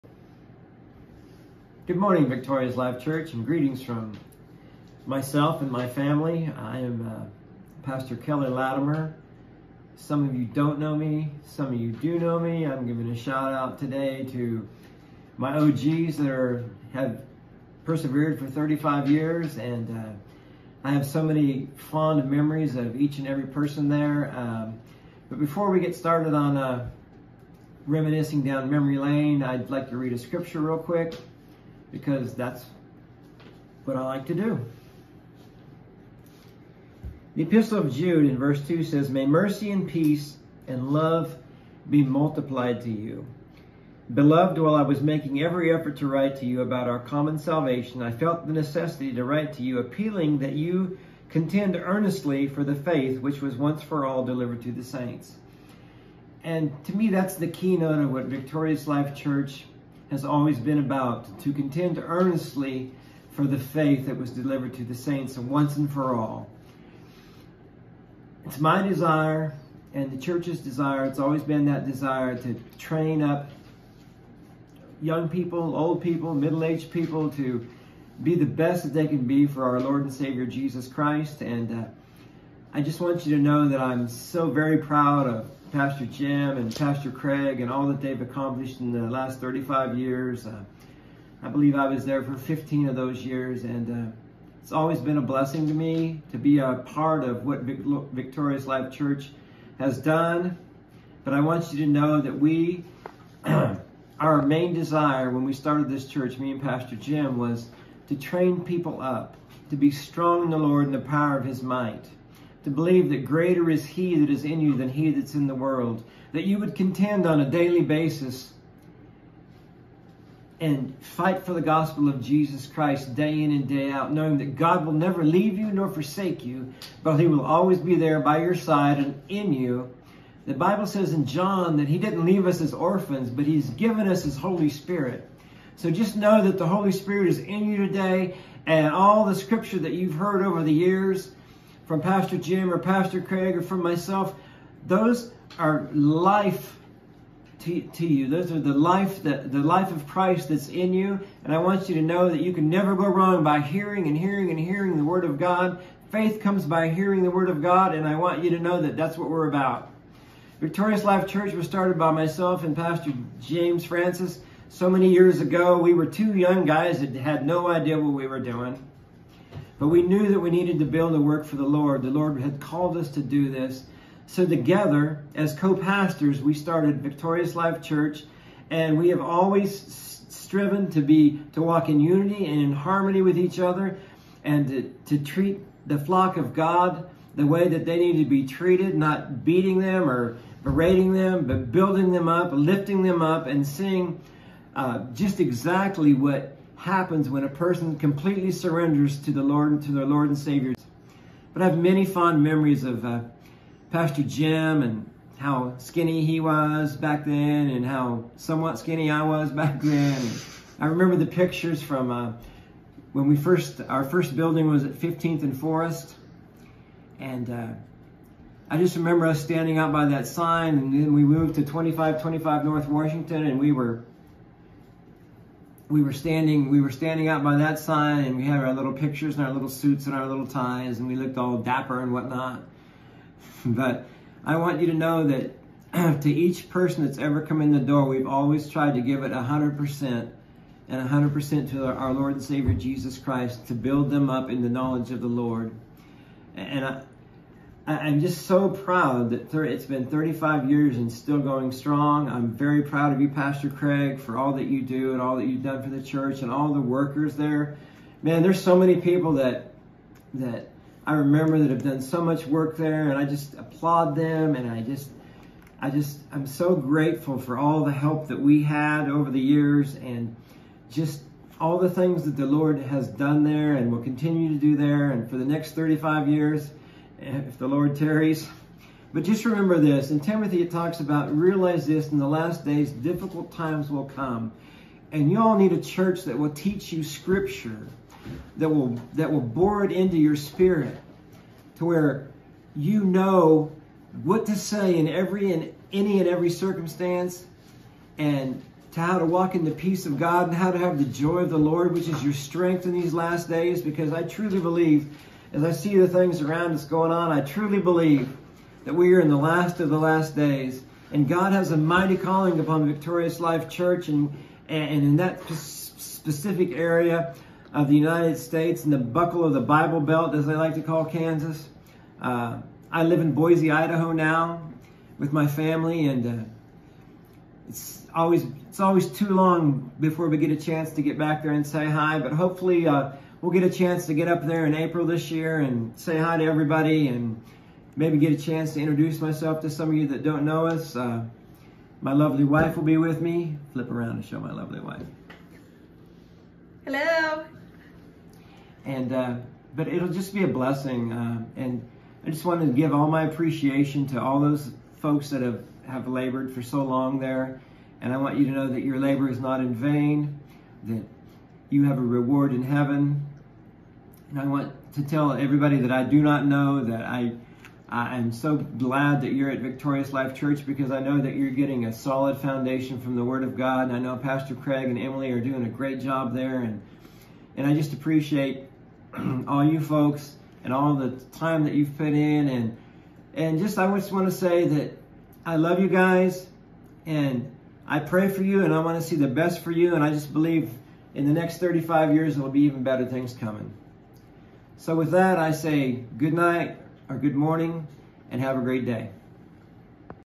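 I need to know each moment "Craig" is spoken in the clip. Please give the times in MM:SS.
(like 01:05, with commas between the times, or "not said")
01:27, 02:23, 04:13, 06:14.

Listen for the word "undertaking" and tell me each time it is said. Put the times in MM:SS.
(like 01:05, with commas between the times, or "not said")
not said.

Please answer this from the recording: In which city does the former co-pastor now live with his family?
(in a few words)
Boise, Idaho.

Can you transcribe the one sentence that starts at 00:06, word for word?
I am uh, Pastor Kelly Latimer.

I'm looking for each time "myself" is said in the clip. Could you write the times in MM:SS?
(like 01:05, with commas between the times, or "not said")
00:05, 02:23, 02:42, 05:39.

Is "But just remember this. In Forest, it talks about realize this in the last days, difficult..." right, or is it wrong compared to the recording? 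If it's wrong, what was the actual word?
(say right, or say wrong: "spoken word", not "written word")
wrong: "Timothy", not "Forest".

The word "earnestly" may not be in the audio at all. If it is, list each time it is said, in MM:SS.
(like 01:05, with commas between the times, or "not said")
00:51, 01:01.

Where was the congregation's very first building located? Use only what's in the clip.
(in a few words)
15th and Forest.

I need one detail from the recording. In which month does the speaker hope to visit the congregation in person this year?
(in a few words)
April.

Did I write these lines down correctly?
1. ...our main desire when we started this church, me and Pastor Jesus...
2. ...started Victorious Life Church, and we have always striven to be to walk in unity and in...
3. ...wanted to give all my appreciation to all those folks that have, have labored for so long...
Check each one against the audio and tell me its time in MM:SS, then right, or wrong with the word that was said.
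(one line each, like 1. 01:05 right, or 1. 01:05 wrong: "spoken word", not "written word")
1. 01:43 wrong: "Jim", not "Jesus"
2. 02:56 right
3. 05:52 right.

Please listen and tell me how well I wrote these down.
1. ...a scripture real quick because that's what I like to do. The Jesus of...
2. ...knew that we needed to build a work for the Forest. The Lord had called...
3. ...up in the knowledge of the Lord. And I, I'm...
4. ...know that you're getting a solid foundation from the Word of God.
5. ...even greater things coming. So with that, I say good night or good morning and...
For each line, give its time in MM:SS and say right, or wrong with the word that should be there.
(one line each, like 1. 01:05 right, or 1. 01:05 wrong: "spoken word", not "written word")
1. 00:30 wrong: "Epistle", not "Jesus"
2. 02:50 wrong: "Lord", not "Forest"
3. 04:04 right
4. 06:10 right
5. 06:32 wrong: "better", not "greater".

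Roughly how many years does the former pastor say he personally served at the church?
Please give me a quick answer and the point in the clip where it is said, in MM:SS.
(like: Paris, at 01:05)
15, at 01:32.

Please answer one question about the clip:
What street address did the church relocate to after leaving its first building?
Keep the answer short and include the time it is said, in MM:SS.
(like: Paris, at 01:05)
2525 North Washington, at 03:41.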